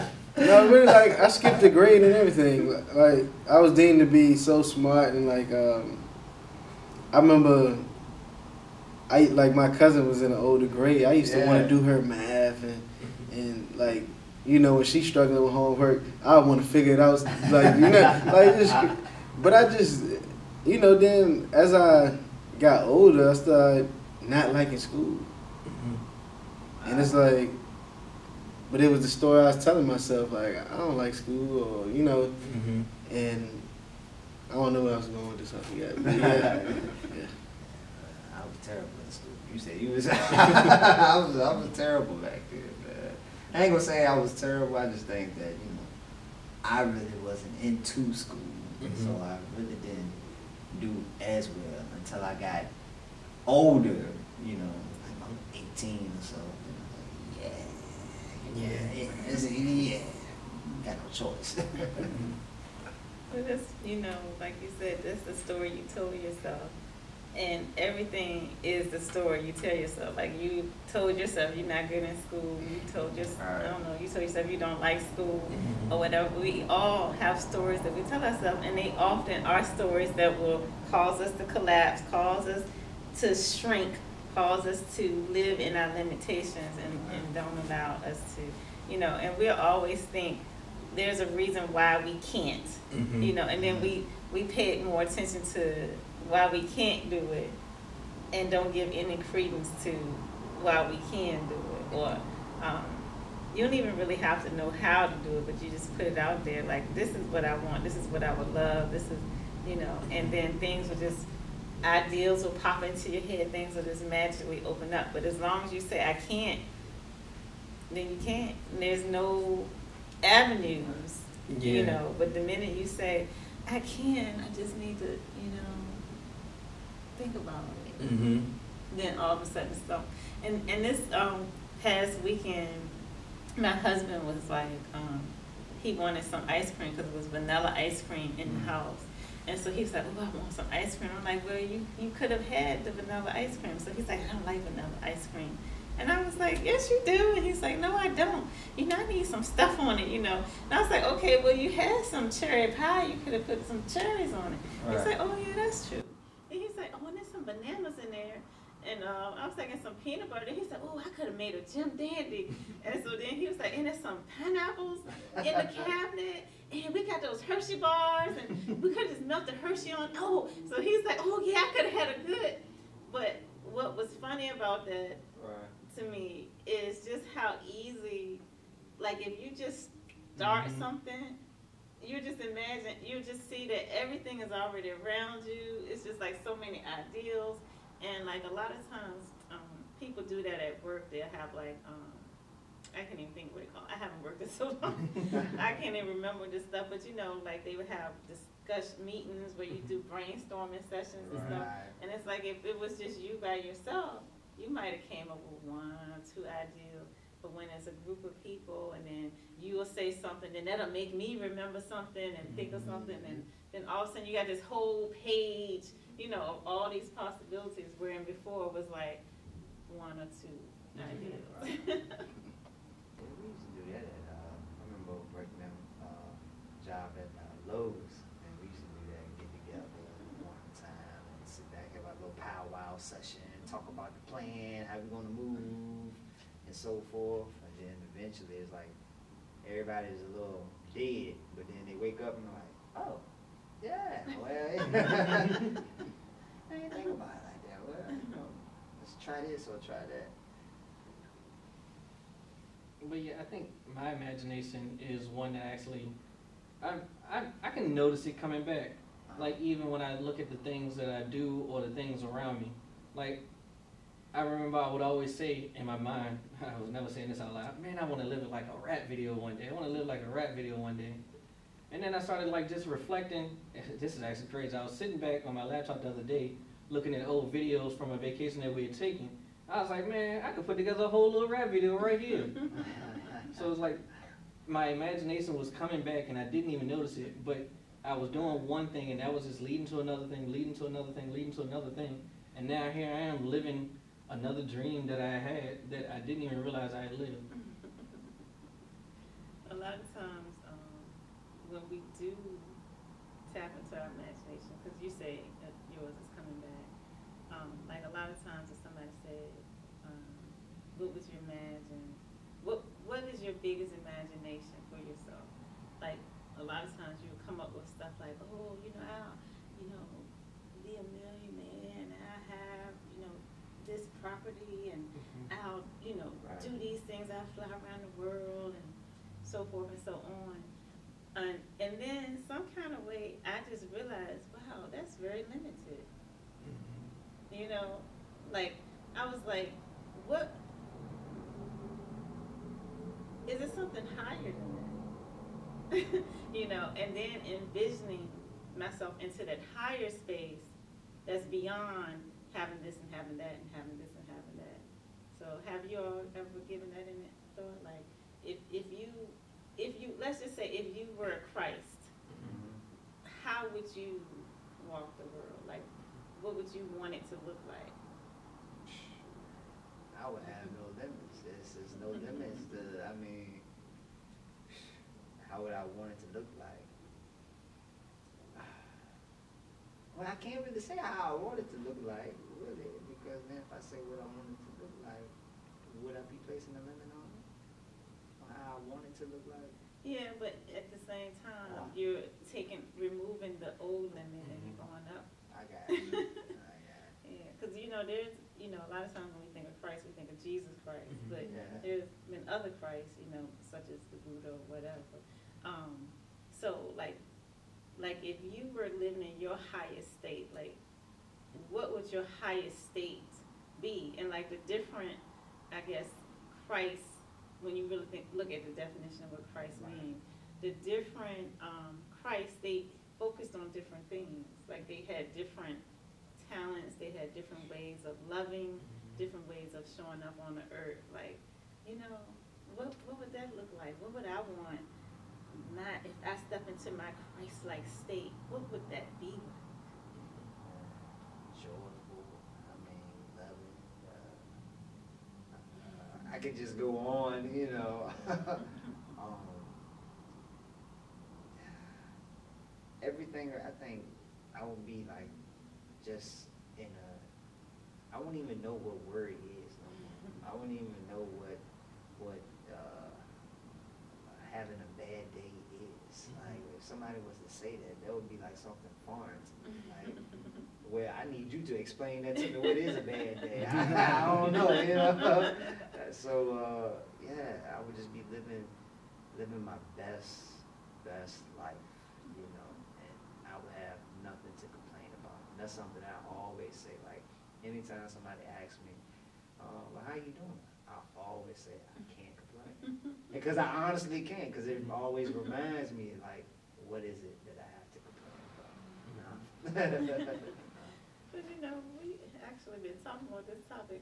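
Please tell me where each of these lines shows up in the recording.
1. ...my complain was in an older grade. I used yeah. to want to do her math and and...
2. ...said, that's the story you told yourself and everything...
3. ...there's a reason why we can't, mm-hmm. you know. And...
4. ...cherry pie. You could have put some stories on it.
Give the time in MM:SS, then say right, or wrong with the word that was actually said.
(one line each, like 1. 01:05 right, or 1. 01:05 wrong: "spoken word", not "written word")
1. 00:09 wrong: "cousin", not "complain"
2. 01:04 right
3. 01:30 right
4. 02:32 wrong: "cherries", not "stories".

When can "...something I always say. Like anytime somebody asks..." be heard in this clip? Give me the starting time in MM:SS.
08:05.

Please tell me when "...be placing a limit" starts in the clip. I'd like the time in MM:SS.
06:26.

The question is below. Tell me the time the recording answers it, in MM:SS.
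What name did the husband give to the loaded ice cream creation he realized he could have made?
02:41.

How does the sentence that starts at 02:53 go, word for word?
But what was funny about that right.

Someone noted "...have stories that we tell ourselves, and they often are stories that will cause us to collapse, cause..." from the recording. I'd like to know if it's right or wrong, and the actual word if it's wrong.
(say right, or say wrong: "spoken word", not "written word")
right.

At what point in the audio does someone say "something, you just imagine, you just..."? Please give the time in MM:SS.
03:00.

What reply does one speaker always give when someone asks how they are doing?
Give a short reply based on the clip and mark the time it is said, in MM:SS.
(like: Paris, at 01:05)
I can't complain, at 08:11.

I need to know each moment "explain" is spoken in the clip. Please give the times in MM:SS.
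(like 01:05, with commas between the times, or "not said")
07:51.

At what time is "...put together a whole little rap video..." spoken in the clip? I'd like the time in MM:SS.
04:40.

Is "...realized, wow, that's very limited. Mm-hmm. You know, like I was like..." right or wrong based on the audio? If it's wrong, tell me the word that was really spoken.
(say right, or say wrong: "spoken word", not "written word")
right.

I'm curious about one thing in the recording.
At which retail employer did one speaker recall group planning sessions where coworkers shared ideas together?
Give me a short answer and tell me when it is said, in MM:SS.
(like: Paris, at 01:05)
Lowe's, at 03:47.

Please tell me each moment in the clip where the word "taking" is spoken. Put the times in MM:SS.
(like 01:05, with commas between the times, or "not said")
02:39, 06:32.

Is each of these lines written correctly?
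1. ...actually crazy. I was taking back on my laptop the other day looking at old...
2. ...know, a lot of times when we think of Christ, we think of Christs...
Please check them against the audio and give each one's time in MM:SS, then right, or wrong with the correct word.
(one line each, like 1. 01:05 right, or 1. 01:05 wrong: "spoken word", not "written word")
1. 04:34 wrong: "sitting", not "taking"
2. 06:38 wrong: "Jesus", not "Christs".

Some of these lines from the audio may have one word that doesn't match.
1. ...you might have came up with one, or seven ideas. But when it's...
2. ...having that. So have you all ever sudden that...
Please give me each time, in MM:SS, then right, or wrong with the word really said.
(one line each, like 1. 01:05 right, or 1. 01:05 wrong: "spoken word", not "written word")
1. 03:24 wrong: "two", not "seven"
2. 05:54 wrong: "given", not "sudden".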